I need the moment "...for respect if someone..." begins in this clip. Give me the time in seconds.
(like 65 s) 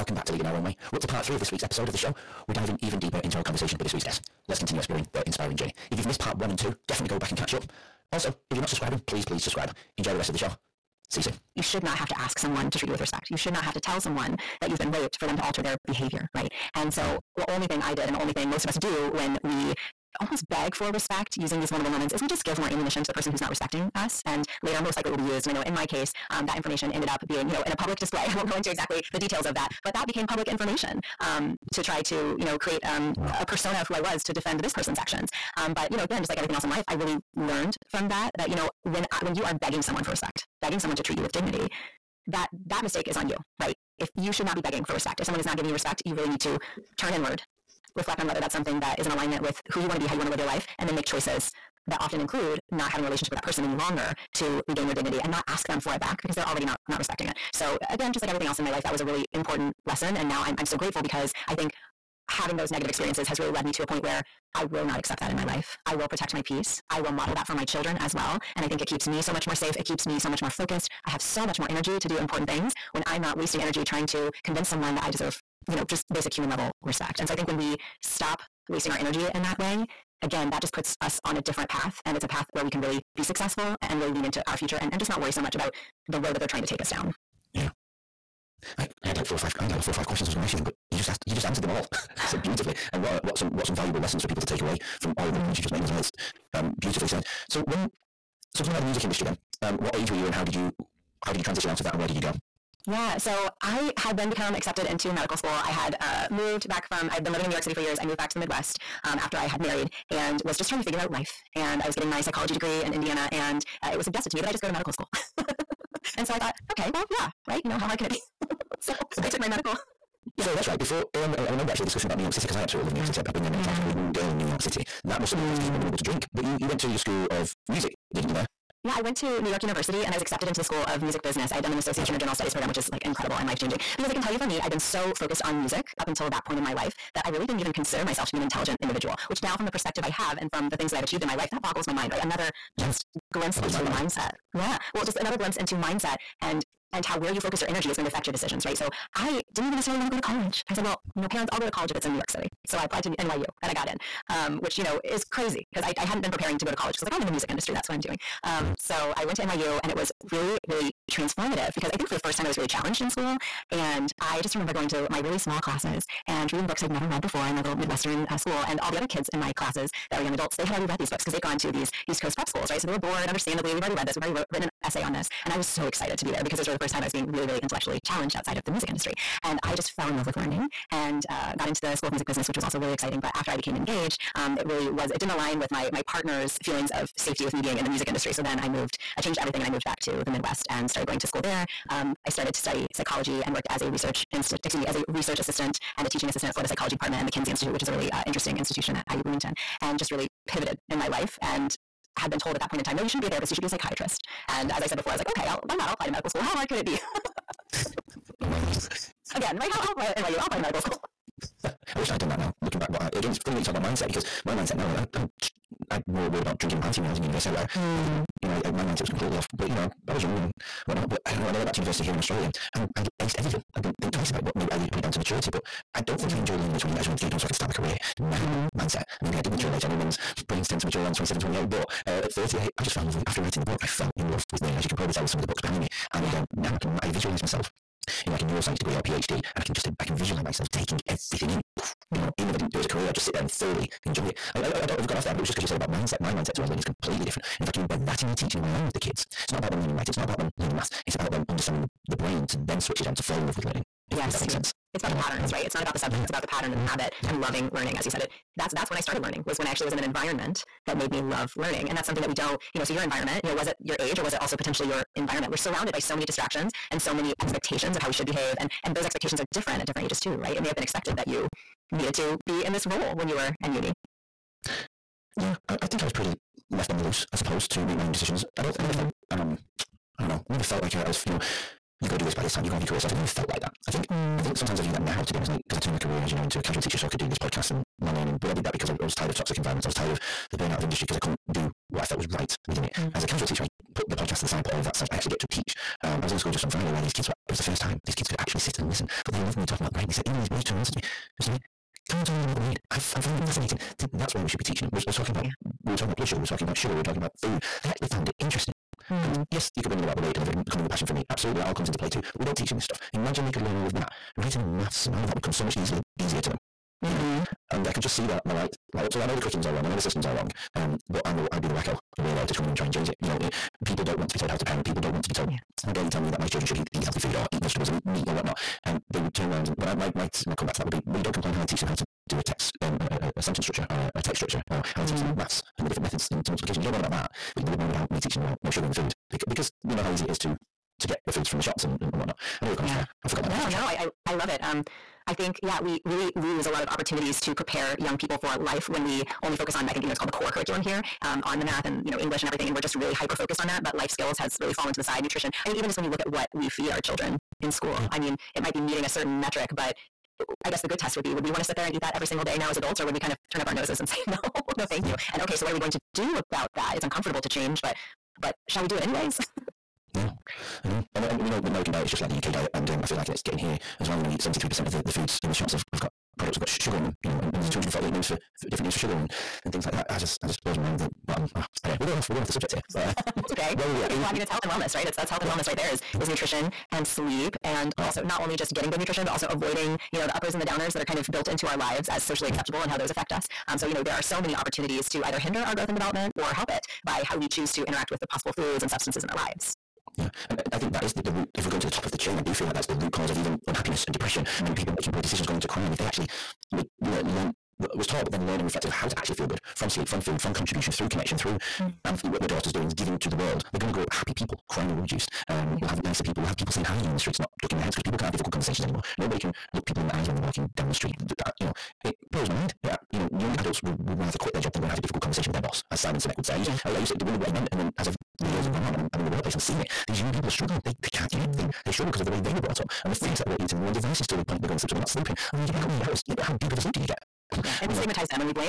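44 s.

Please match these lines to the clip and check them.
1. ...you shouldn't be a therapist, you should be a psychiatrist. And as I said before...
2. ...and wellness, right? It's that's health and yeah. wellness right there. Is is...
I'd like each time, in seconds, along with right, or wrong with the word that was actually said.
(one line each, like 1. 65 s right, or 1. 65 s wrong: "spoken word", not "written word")
1. 203 s right
2. 384 s right.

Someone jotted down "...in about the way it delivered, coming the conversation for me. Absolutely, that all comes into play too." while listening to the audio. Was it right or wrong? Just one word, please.
wrong.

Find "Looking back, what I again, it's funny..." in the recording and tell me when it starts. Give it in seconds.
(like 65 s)
212 s.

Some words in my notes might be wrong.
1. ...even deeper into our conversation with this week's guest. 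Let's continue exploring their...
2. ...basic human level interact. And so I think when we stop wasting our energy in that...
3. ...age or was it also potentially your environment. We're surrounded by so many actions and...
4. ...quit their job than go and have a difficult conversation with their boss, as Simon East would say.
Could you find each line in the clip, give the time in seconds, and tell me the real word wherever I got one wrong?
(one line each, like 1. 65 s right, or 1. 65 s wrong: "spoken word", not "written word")
1. 2 s right
2. 76 s wrong: "respect", not "interact"
3. 264 s wrong: "distractions", not "actions"
4. 424 s wrong: "Sinek", not "East".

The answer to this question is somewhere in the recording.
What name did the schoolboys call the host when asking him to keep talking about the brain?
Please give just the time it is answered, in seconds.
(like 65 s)
301 s.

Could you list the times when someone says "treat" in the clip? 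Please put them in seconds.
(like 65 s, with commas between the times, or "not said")
12 s, 41 s.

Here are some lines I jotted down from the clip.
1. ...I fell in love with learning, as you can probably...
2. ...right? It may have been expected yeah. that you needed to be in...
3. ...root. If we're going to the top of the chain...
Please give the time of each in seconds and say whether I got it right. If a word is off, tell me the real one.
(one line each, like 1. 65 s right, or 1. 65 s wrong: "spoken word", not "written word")
1. 233 s right
2. 270 s right
3. 401 s right.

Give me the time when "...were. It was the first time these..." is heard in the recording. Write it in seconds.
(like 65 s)
297 s.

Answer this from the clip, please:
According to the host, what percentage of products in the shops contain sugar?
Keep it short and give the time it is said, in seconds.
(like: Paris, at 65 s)
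73%, at 374 s.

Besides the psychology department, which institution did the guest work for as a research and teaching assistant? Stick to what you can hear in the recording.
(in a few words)
Kinsey Institute.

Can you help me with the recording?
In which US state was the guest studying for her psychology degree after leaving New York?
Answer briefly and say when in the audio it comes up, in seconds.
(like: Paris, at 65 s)
Indiana, at 112 s.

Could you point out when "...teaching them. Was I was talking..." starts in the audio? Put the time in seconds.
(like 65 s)
304 s.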